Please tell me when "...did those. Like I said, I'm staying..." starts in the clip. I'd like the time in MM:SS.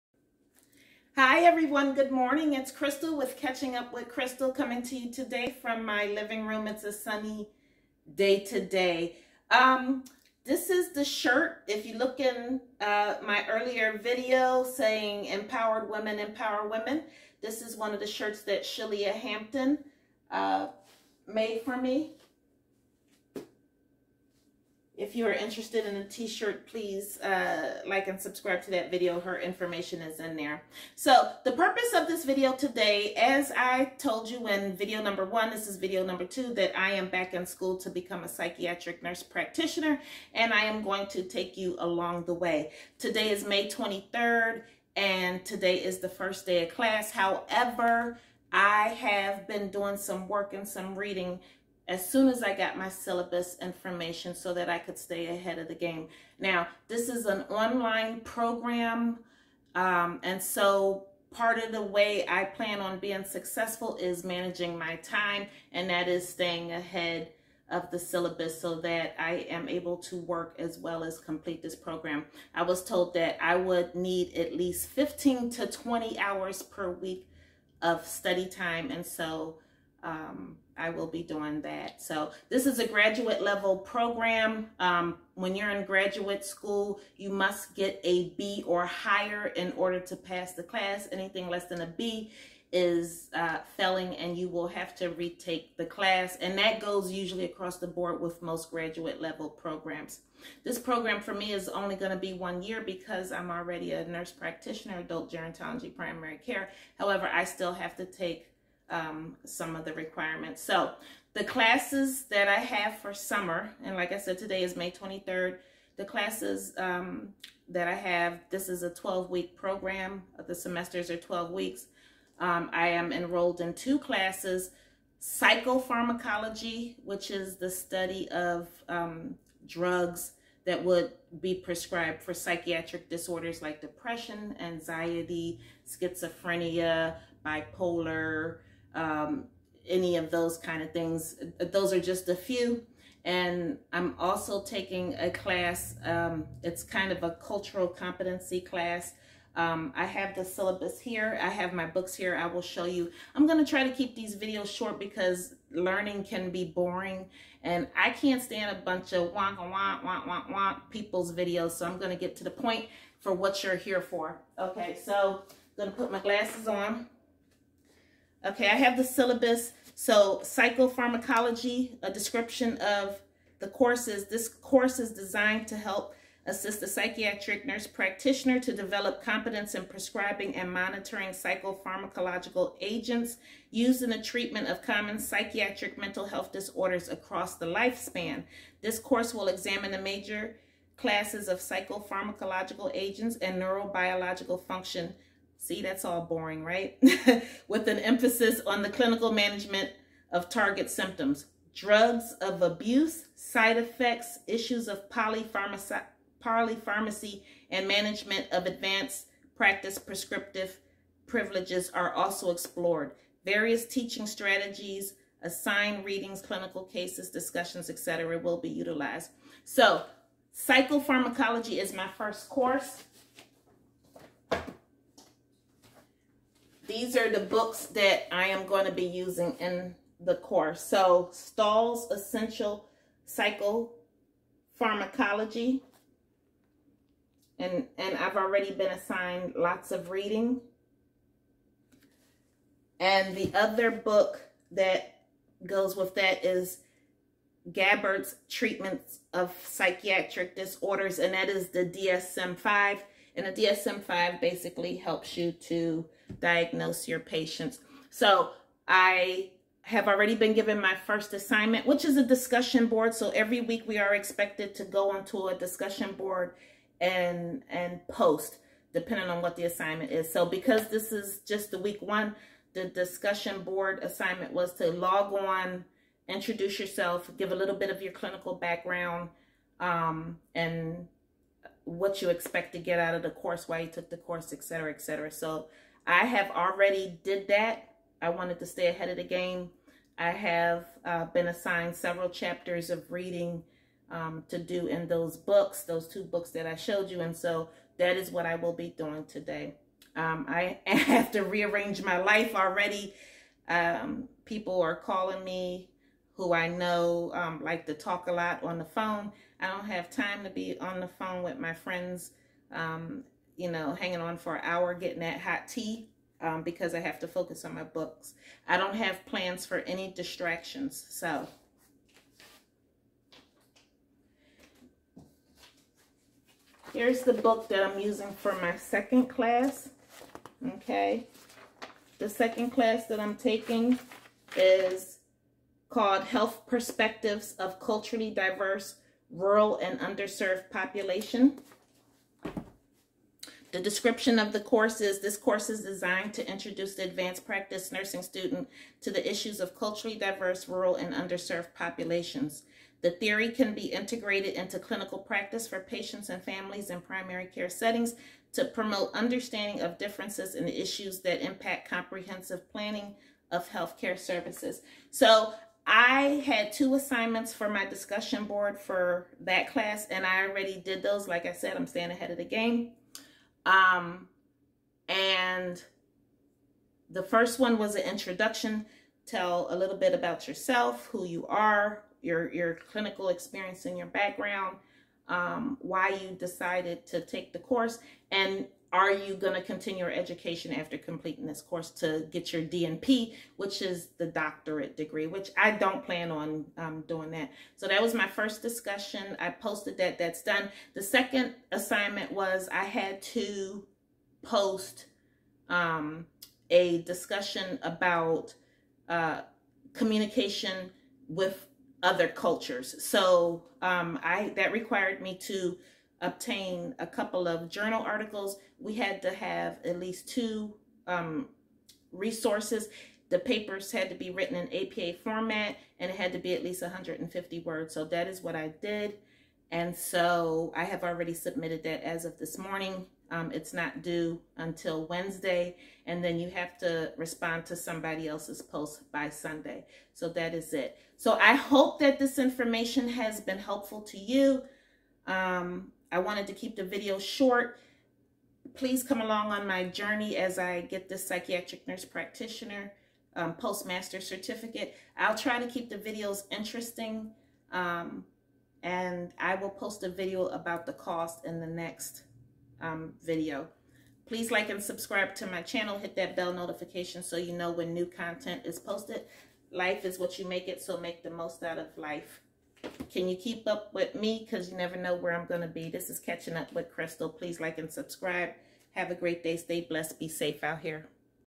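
06:10.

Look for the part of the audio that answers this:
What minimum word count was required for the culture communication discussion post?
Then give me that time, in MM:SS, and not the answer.
07:06.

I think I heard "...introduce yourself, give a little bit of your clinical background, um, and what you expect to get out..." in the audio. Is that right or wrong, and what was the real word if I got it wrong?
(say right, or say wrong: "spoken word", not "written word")
right.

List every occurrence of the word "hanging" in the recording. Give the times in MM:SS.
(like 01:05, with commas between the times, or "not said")
05:13.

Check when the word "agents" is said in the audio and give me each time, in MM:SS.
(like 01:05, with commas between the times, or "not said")
03:02, 03:12.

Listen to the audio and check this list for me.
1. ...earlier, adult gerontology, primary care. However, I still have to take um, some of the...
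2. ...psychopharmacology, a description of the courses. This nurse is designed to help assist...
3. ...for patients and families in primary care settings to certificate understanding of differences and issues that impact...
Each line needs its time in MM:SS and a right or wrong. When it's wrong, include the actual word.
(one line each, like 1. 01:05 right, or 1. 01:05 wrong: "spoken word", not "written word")
1. 01:44 wrong: "practitioner", not "earlier"
2. 02:50 wrong: "course", not "nurse"
3. 05:55 wrong: "promote", not "certificate".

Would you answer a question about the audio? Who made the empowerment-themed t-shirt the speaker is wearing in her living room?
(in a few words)
Shelia Hampton.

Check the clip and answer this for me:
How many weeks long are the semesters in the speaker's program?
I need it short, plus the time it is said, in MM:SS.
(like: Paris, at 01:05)
12, at 01:58.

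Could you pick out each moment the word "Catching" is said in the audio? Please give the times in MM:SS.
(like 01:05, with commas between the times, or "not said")
00:03, 07:56.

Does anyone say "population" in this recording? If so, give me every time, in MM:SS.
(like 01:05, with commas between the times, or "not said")
05:40, 05:51.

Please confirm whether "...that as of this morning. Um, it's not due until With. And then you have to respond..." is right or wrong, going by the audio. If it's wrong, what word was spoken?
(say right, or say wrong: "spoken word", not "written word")
wrong: "Wednesday", not "With".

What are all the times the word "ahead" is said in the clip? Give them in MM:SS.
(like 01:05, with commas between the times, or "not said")
00:55, 01:06, 04:48, 06:12.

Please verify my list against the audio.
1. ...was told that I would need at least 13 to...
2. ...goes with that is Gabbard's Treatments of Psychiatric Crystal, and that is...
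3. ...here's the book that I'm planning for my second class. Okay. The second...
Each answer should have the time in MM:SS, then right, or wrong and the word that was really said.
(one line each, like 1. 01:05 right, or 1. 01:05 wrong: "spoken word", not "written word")
1. 01:12 wrong: "15", not "13"
2. 04:05 wrong: "Disorders", not "Crystal"
3. 05:26 wrong: "using", not "planning".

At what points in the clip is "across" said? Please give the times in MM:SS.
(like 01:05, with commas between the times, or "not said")
01:37, 03:07.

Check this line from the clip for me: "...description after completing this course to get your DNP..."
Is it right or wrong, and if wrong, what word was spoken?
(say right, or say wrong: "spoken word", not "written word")
wrong: "education", not "description".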